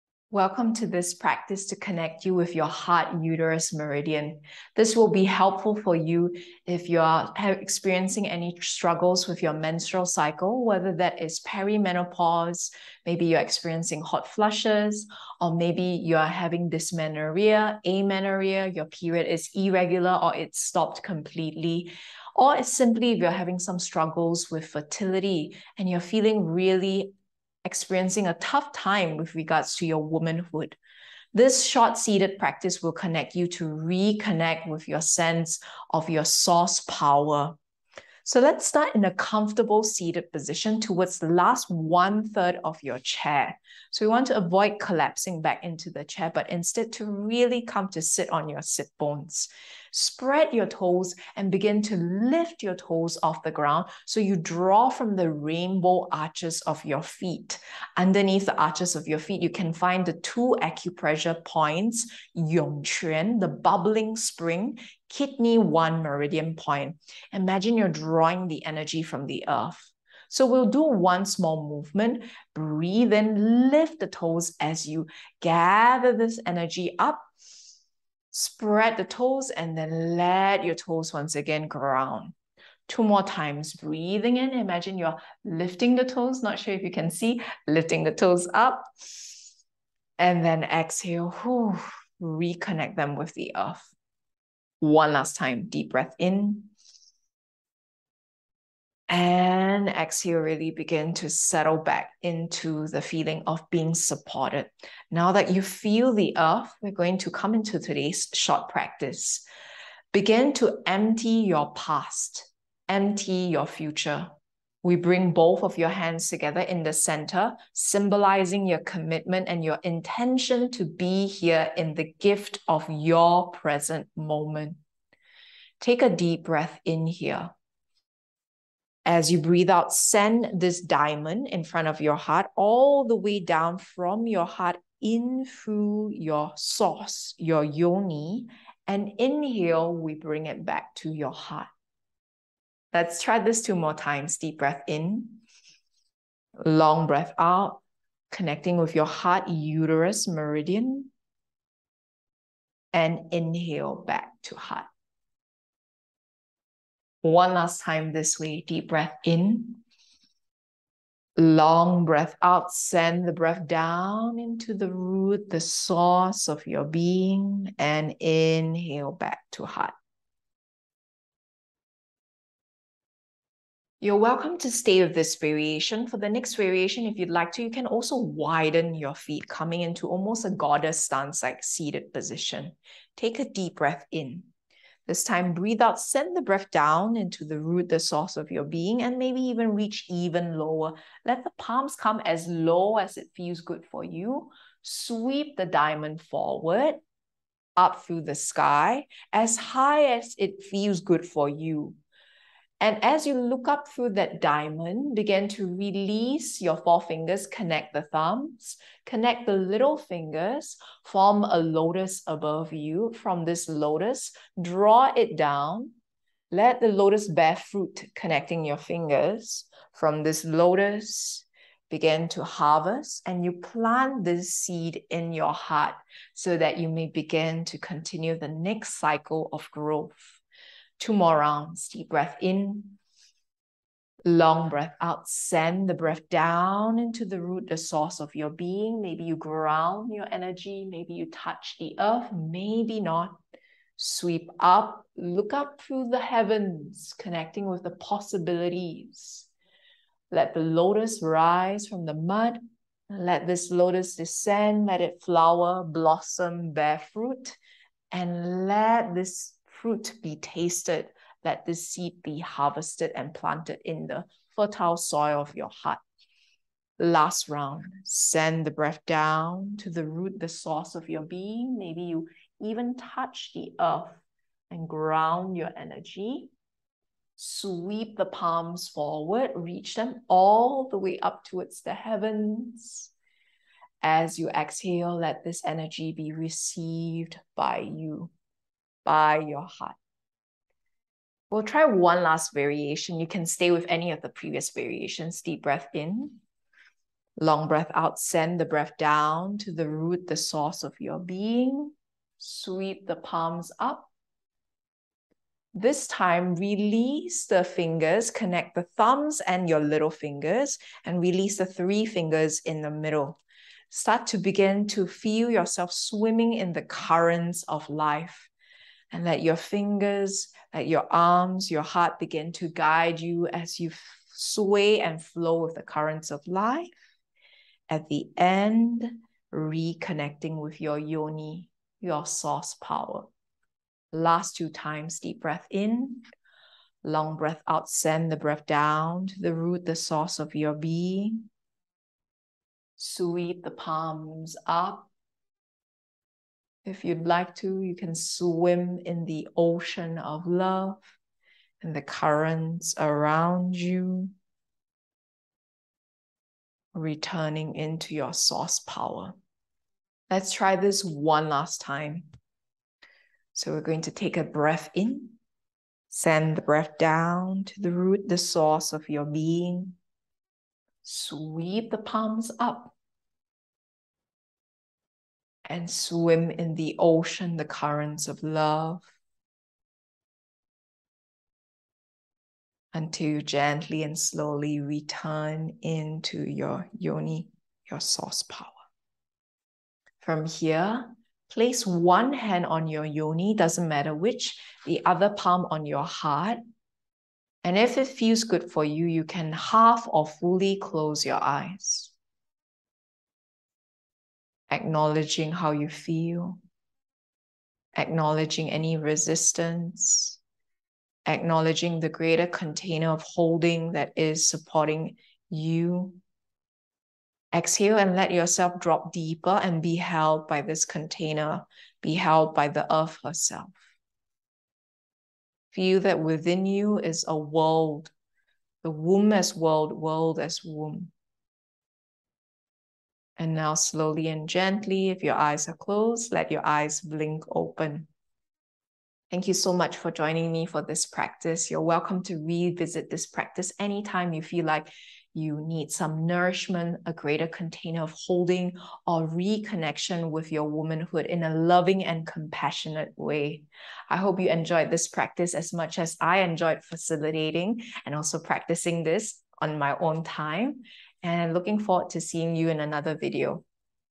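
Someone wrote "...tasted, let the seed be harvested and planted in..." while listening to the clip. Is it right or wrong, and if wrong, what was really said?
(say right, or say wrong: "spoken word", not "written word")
right.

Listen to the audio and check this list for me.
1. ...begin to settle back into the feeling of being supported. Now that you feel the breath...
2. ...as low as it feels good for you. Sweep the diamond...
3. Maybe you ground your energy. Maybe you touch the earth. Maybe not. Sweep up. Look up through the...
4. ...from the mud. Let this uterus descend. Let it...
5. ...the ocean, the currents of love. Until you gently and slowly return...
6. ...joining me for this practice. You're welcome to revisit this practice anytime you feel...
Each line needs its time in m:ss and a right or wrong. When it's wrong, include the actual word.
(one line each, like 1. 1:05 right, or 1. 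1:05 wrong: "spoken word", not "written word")
1. 1:40 wrong: "earth", not "breath"
2. 3:12 right
3. 3:59 right
4. 4:11 wrong: "lotus", not "uterus"
5. 6:16 right
6. 7:20 right.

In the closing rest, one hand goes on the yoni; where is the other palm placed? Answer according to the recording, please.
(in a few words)
on your heart.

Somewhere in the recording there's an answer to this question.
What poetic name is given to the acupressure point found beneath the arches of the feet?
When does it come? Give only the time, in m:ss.
1:03.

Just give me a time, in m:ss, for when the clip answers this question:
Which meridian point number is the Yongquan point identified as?
1:05.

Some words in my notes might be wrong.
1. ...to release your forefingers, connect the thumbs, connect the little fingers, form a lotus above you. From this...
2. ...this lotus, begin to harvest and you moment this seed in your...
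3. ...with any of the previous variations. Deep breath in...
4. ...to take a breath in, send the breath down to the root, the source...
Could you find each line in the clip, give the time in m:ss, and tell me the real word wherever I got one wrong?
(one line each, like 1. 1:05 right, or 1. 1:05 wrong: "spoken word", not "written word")
1. 3:25 right
2. 3:40 wrong: "plant", not "moment"
3. 4:53 right
4. 6:04 right.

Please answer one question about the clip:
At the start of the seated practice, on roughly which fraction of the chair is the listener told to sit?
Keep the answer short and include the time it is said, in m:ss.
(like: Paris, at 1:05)
last one third, at 0:41.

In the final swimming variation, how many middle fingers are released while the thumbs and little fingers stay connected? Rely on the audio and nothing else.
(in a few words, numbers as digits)
3.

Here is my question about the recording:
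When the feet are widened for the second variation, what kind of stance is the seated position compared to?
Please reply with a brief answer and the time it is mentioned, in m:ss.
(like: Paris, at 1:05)
goddess stance, at 3:00.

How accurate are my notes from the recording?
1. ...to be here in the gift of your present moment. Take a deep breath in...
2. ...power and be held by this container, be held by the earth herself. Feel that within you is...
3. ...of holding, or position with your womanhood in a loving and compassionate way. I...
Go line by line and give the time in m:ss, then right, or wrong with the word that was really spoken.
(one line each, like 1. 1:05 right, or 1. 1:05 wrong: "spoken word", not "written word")
1. 2:00 right
2. 6:59 wrong: "deeper", not "power"
3. 7:28 wrong: "reconnection", not "position".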